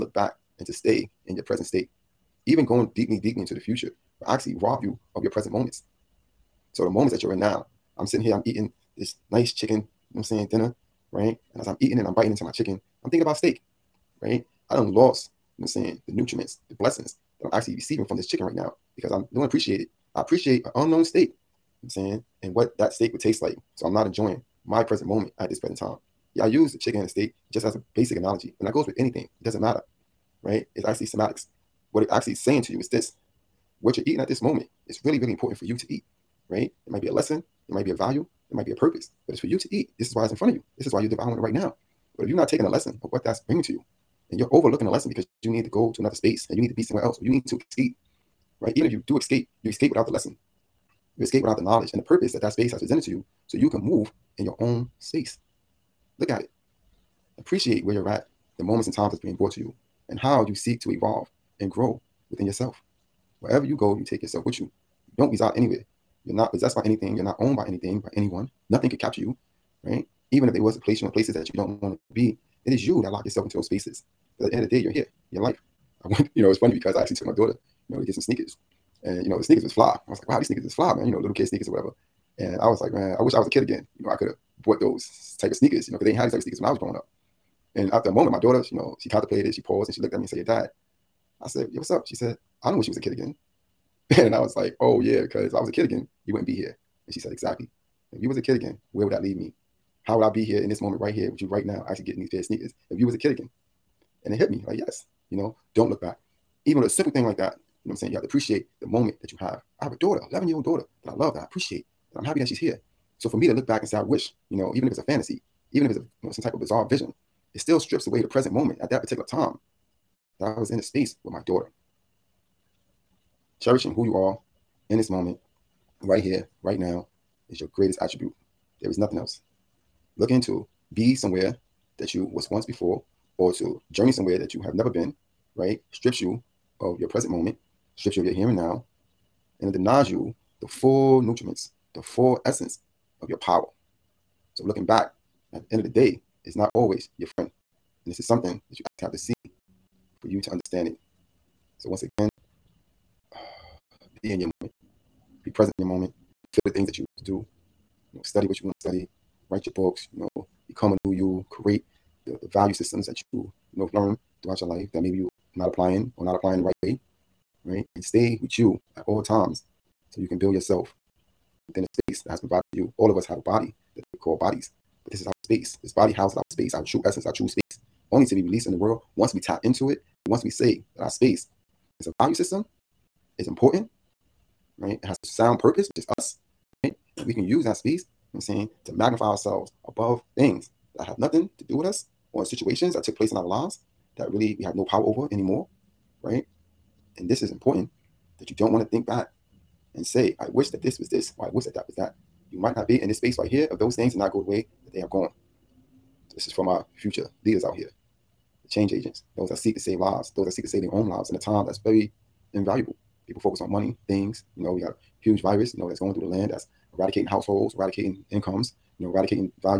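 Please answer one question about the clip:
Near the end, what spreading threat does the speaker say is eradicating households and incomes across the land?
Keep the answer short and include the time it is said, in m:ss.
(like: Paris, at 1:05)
a huge virus, at 3:34.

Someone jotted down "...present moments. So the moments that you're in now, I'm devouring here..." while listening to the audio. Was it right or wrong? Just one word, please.
wrong.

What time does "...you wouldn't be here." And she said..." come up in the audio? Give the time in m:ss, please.
1:36.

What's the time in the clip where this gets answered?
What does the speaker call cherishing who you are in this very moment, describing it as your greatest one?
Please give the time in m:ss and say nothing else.
2:08.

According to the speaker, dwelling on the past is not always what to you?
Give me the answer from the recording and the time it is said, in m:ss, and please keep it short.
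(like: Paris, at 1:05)
your friend, at 2:27.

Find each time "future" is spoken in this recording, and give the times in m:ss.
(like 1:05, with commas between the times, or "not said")
0:03, 3:26.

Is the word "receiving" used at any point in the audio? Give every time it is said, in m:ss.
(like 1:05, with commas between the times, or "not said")
0:17.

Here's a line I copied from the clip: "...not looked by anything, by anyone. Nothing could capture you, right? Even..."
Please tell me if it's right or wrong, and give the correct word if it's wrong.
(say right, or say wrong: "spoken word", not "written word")
wrong: "owned", not "looked".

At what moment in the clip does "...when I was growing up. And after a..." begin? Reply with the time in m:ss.
1:26.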